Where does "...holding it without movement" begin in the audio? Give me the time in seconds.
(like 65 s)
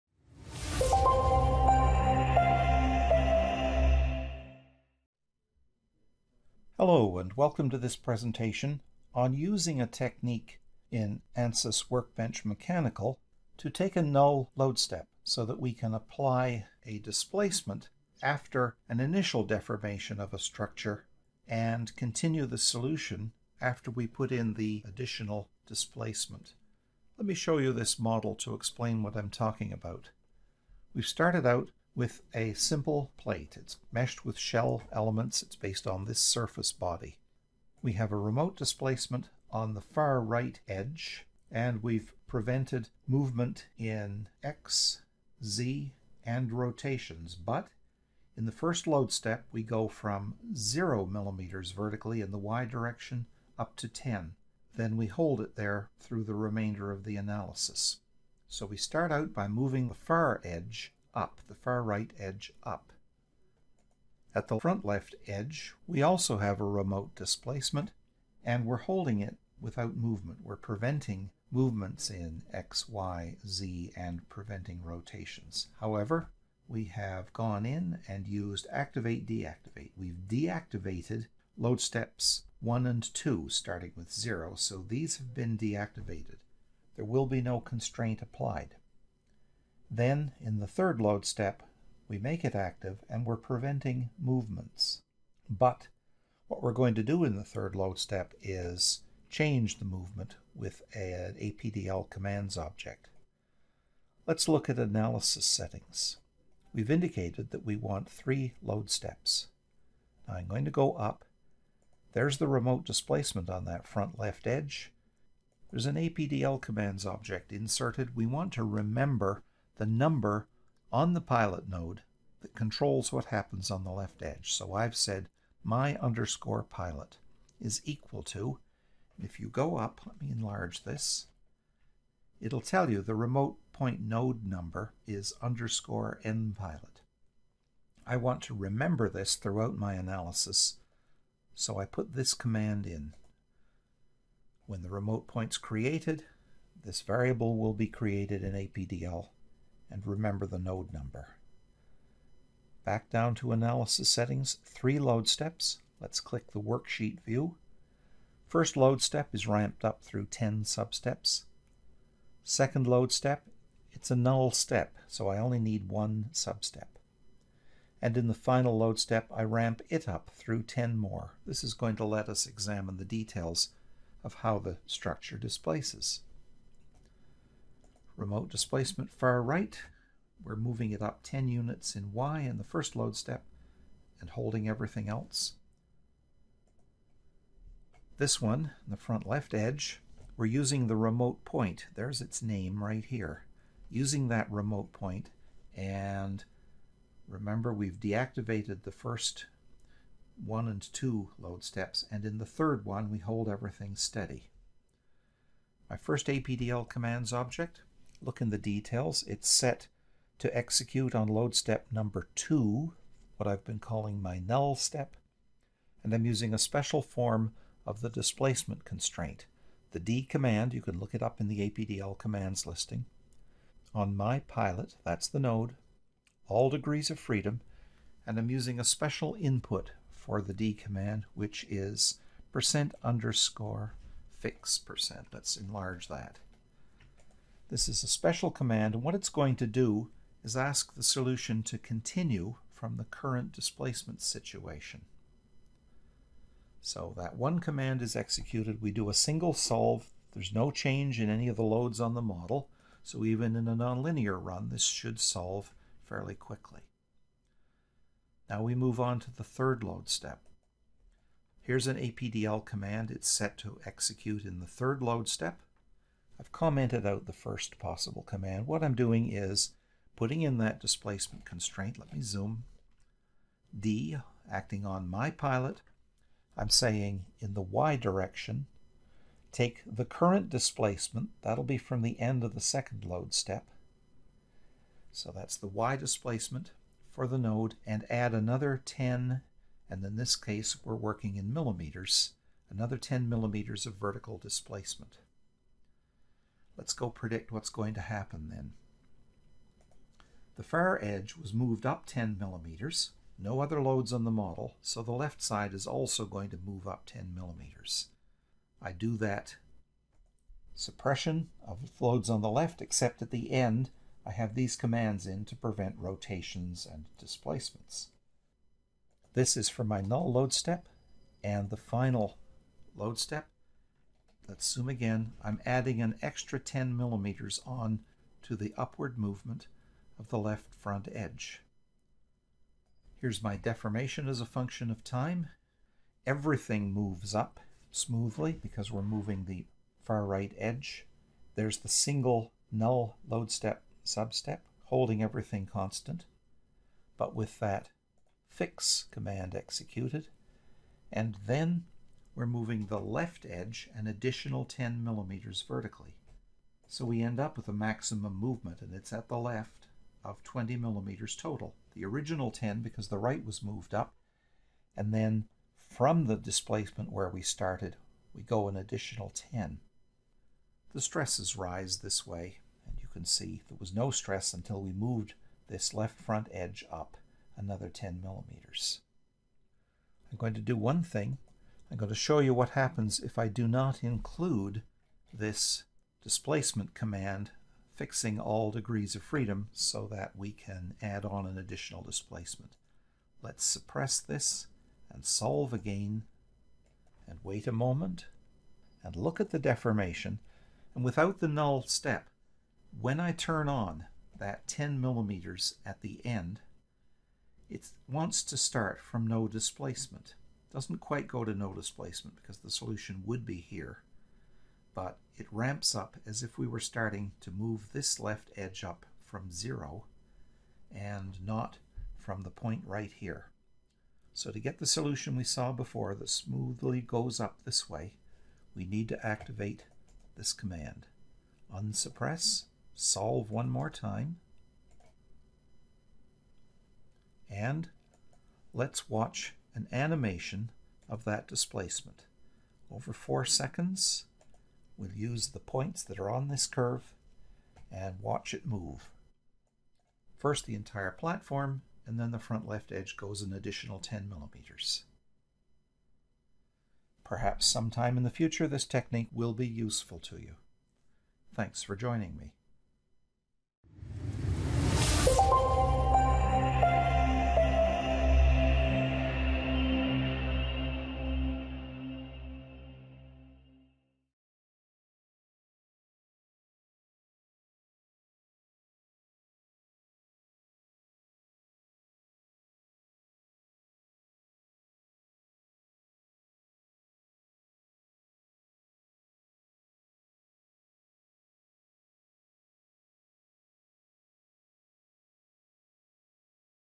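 68 s.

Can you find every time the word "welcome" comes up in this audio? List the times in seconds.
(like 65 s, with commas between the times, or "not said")
7 s.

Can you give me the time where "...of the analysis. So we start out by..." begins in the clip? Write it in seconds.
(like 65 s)
56 s.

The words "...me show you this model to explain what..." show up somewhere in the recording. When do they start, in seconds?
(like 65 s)
27 s.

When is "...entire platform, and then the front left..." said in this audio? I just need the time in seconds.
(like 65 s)
450 s.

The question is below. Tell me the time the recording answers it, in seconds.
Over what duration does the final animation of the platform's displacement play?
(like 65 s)
443 s.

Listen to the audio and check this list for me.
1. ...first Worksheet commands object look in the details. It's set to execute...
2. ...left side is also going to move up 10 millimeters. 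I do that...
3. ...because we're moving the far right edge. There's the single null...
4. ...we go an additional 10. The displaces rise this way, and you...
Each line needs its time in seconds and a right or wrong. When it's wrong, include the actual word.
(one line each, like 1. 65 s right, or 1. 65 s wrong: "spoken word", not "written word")
1. 205 s wrong: "APDL", not "Worksheet"
2. 305 s right
3. 338 s right
4. 368 s wrong: "stresses", not "displaces".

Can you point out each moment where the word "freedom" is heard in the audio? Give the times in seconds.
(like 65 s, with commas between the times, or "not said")
227 s, 389 s.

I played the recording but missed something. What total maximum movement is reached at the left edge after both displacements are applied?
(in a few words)
20 millimeters.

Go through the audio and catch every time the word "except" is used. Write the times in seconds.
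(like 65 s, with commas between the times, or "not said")
312 s.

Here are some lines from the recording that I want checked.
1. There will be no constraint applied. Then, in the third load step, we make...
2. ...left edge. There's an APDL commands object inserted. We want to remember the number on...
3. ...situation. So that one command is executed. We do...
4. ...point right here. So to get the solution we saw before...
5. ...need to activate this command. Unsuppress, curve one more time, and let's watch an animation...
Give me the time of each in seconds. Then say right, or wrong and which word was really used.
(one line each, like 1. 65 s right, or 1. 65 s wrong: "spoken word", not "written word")
1. 86 s right
2. 114 s right
3. 244 s right
4. 422 s right
5. 428 s wrong: "solve", not "curve".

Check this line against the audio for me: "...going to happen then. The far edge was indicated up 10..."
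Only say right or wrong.
wrong.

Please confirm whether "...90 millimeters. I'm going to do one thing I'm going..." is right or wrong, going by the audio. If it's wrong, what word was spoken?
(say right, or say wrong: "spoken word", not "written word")
wrong: "10", not "90".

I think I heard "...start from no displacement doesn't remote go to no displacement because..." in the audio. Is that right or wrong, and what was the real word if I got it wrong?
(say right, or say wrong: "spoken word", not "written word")
wrong: "quite", not "remote".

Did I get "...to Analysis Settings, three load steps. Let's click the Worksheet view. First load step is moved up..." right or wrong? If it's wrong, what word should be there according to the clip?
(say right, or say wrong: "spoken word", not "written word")
wrong: "ramped", not "moved".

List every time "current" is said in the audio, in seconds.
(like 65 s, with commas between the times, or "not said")
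243 s, 280 s.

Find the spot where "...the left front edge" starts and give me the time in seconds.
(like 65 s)
330 s.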